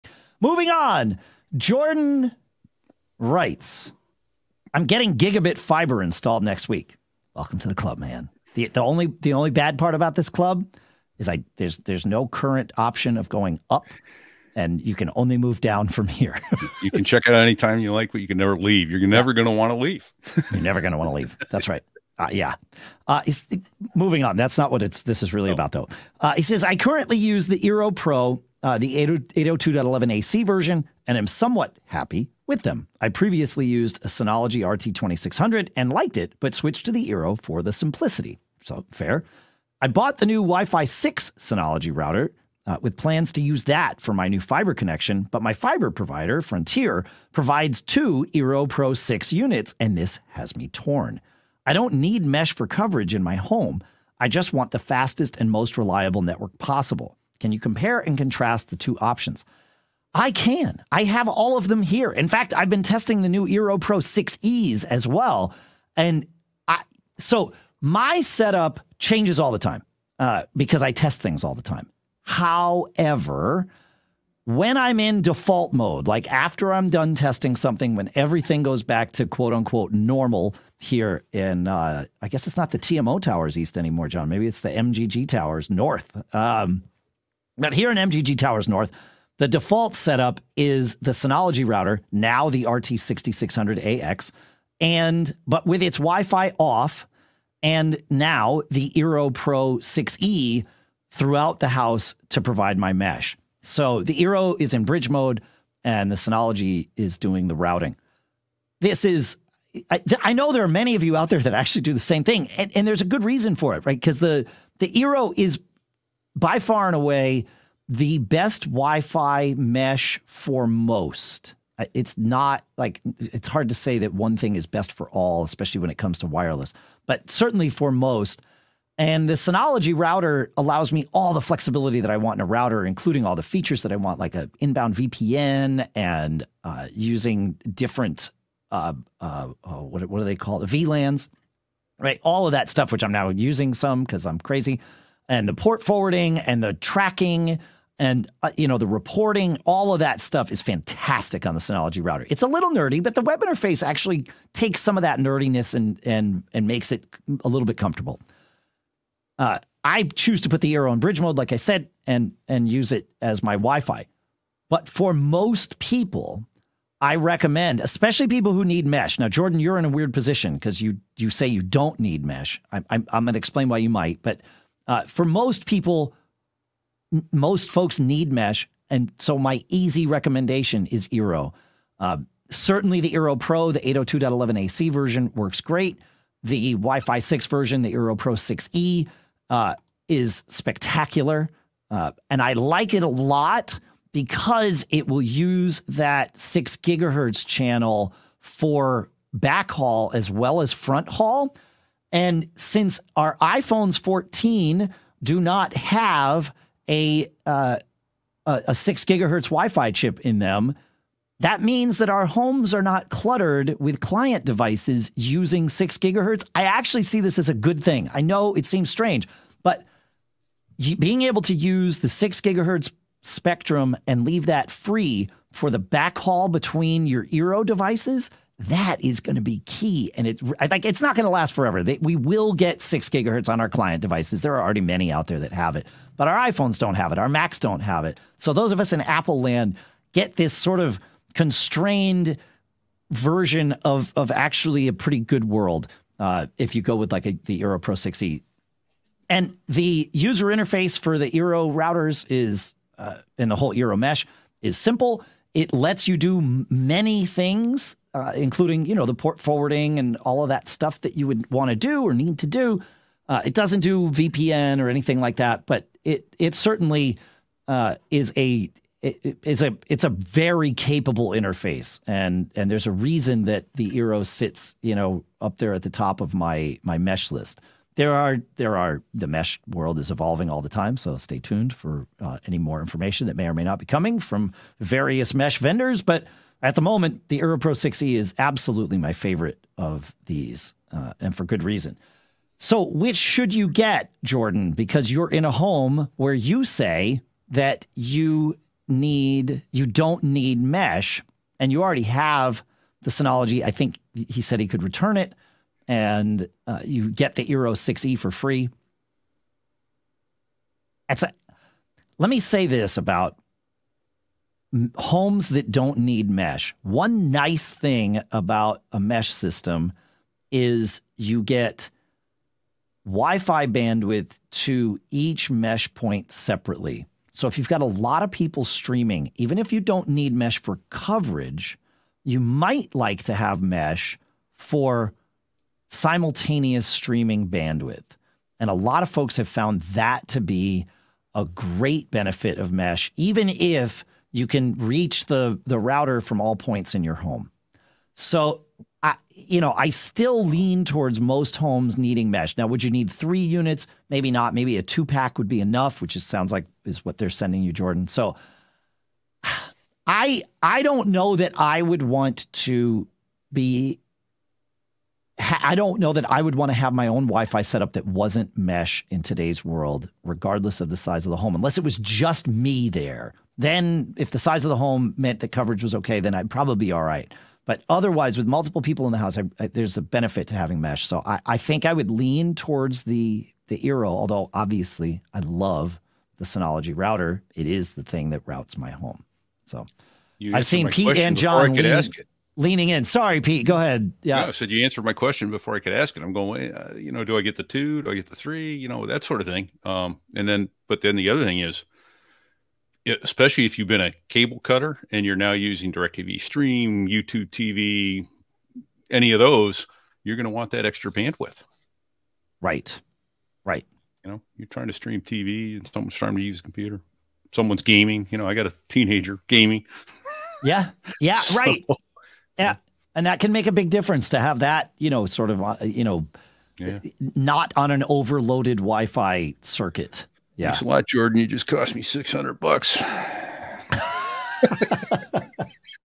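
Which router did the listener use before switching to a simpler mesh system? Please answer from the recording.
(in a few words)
Synology RT2600.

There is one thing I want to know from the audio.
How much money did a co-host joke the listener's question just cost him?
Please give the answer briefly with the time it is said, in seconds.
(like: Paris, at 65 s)
$600, at 432 s.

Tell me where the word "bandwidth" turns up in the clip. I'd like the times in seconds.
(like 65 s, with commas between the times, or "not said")
323 s, 337 s, 411 s.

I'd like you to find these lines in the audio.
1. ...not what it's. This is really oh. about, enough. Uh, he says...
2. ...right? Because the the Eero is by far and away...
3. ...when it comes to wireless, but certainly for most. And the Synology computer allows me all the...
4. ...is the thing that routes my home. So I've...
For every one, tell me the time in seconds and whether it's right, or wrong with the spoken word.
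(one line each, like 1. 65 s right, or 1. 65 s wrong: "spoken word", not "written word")
1. 24 s wrong: "though", not "enough"
2. 113 s right
3. 125 s wrong: "router", not "computer"
4. 387 s right.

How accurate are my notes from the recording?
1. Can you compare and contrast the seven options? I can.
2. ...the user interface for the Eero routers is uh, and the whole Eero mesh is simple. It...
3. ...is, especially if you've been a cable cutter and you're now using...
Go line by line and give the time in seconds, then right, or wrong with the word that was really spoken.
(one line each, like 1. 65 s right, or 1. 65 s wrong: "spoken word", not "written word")
1. 57 s wrong: "two", not "seven"
2. 249 s right
3. 401 s right.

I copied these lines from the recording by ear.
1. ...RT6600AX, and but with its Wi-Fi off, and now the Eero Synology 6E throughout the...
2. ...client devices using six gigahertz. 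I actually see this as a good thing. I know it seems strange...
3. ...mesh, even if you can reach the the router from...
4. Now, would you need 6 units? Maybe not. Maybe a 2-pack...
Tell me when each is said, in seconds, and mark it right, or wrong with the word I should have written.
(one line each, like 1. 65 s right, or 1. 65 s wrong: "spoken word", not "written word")
1. 92 s wrong: "Pro", not "Synology"
2. 213 s right
3. 342 s right
4. 352 s wrong: "3", not "6".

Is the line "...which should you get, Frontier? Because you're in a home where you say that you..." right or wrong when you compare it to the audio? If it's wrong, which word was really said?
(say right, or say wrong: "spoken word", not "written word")
wrong: "Jordan", not "Frontier".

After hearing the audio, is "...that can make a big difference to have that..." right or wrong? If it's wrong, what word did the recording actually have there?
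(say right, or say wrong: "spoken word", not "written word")
right.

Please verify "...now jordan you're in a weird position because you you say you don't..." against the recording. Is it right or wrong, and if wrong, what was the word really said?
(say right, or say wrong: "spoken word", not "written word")
right.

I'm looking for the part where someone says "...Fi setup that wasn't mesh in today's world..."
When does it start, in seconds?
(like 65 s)
367 s.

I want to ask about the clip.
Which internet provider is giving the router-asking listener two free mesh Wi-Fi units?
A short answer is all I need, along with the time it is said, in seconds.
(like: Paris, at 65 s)
Frontier, at 46 s.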